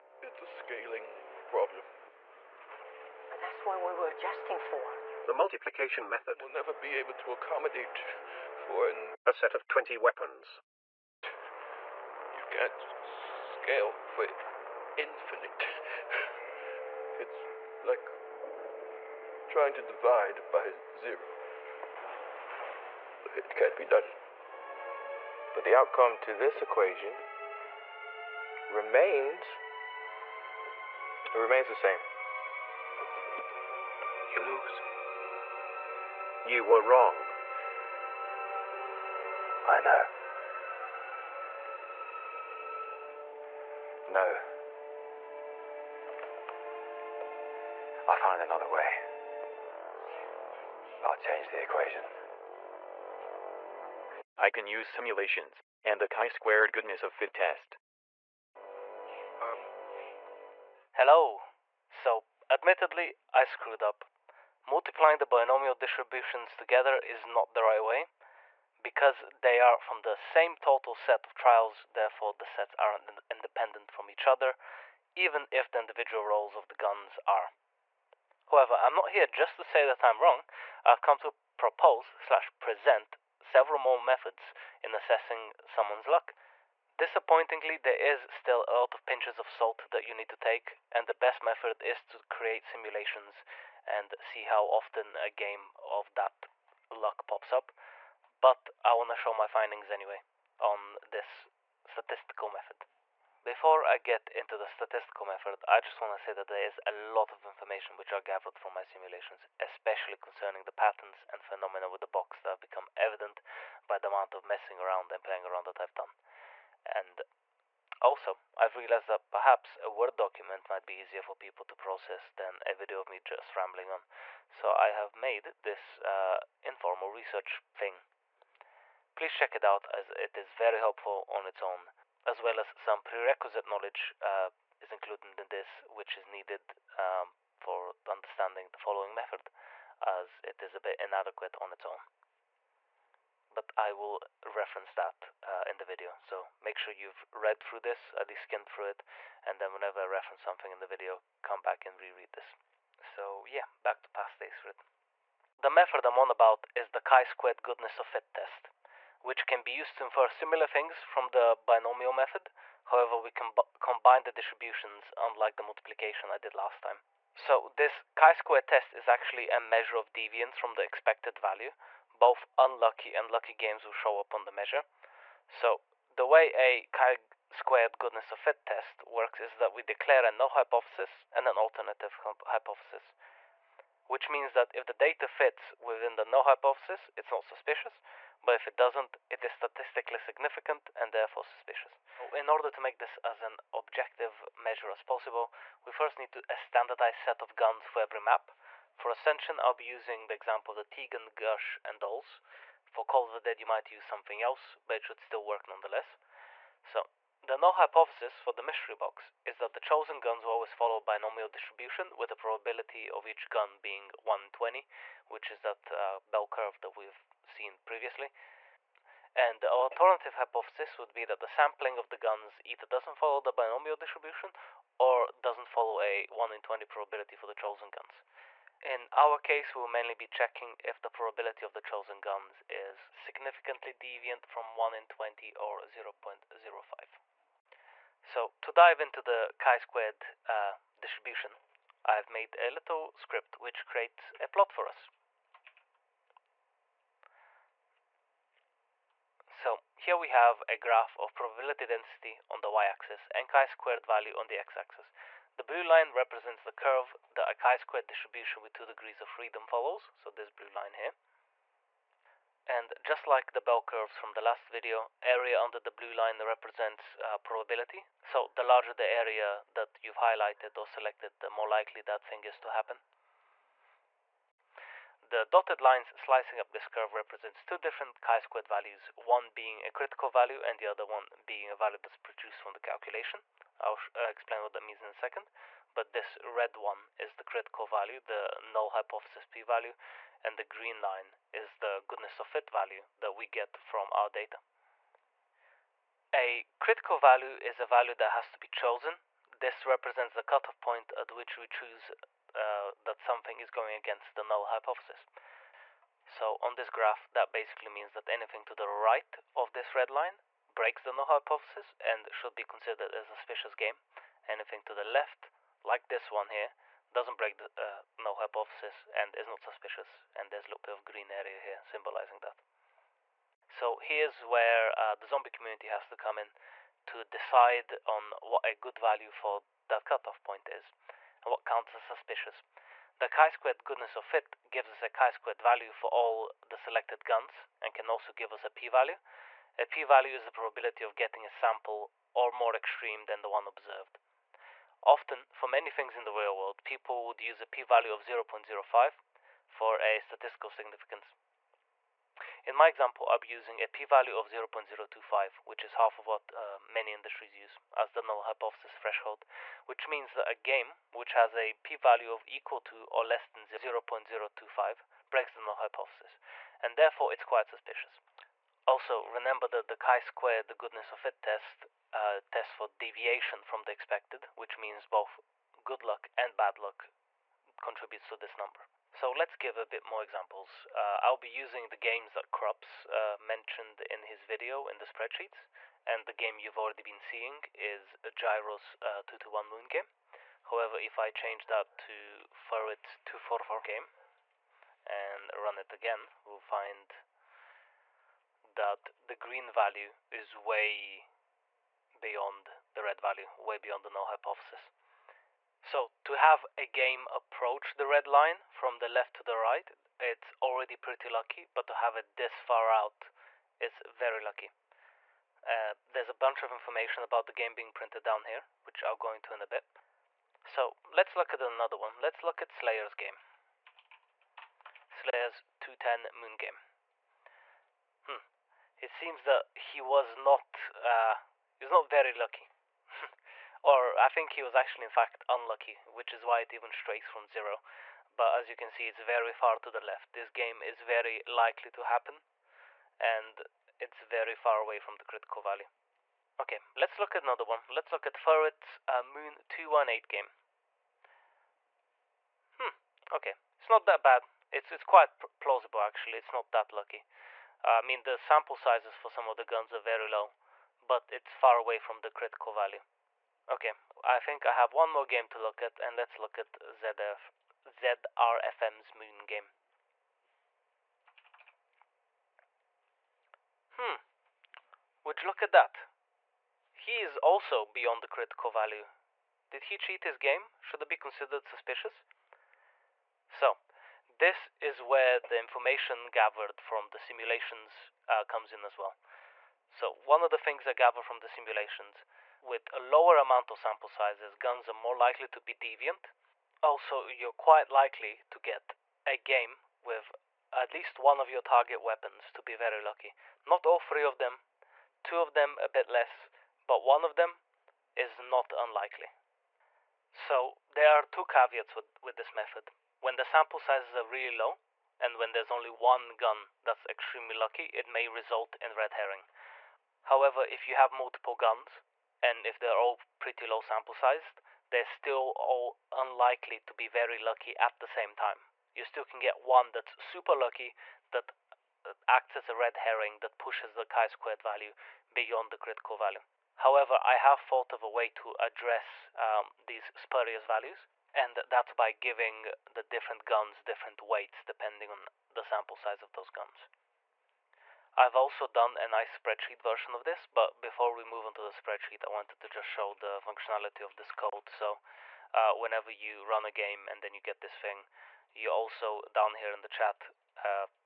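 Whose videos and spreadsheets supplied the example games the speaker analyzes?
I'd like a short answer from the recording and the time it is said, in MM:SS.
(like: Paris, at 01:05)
Cruppz, at 06:22.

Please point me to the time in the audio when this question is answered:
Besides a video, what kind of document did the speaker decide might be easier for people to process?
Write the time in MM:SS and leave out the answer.
01:59.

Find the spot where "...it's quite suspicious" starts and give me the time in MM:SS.
06:07.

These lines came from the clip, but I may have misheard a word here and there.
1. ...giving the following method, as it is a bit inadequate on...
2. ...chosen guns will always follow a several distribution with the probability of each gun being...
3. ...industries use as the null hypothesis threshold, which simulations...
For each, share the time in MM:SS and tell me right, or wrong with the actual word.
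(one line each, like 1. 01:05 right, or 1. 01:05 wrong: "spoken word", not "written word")
1. 02:18 wrong: "understanding", not "giving"
2. 03:29 wrong: "binomial", not "several"
3. 05:57 wrong: "means", not "simulations".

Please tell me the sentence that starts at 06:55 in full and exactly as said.
Uh, there's a bunch of information about the game being printed down here, which I'll go into in a bit.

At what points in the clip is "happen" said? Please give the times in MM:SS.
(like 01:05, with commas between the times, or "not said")
04:32, 07:22.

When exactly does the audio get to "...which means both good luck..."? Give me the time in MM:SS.
06:14.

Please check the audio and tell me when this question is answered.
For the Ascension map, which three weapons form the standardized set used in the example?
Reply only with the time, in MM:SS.
03:20.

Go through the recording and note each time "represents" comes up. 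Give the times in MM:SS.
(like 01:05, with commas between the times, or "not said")
04:16, 04:26, 04:37, 04:59.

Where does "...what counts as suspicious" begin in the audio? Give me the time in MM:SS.
05:31.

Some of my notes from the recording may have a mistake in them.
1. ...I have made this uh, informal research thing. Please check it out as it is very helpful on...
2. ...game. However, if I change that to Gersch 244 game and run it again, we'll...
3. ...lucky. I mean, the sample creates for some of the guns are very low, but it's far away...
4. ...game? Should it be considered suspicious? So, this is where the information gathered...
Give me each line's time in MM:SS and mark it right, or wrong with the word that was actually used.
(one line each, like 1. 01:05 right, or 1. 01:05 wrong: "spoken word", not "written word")
1. 02:04 right
2. 06:29 wrong: "Furret", not "Gersch"
3. 07:36 wrong: "sizes", not "creates"
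4. 08:00 right.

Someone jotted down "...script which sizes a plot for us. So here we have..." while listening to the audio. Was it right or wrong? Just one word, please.
wrong.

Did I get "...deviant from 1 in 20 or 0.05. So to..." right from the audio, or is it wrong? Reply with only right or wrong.
right.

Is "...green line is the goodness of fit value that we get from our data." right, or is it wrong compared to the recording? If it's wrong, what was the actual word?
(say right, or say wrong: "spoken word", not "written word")
right.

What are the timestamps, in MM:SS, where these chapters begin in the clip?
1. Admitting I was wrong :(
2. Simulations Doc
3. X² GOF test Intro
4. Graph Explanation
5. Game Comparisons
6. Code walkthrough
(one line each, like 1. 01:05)
1. 00:59
2. 01:44
3. 02:34
4. 04:04
5. 06:17
6. 09:11.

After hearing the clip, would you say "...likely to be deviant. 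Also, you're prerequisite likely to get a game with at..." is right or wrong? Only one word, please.
wrong.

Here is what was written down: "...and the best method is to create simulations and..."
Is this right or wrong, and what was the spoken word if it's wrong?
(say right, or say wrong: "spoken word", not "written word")
right.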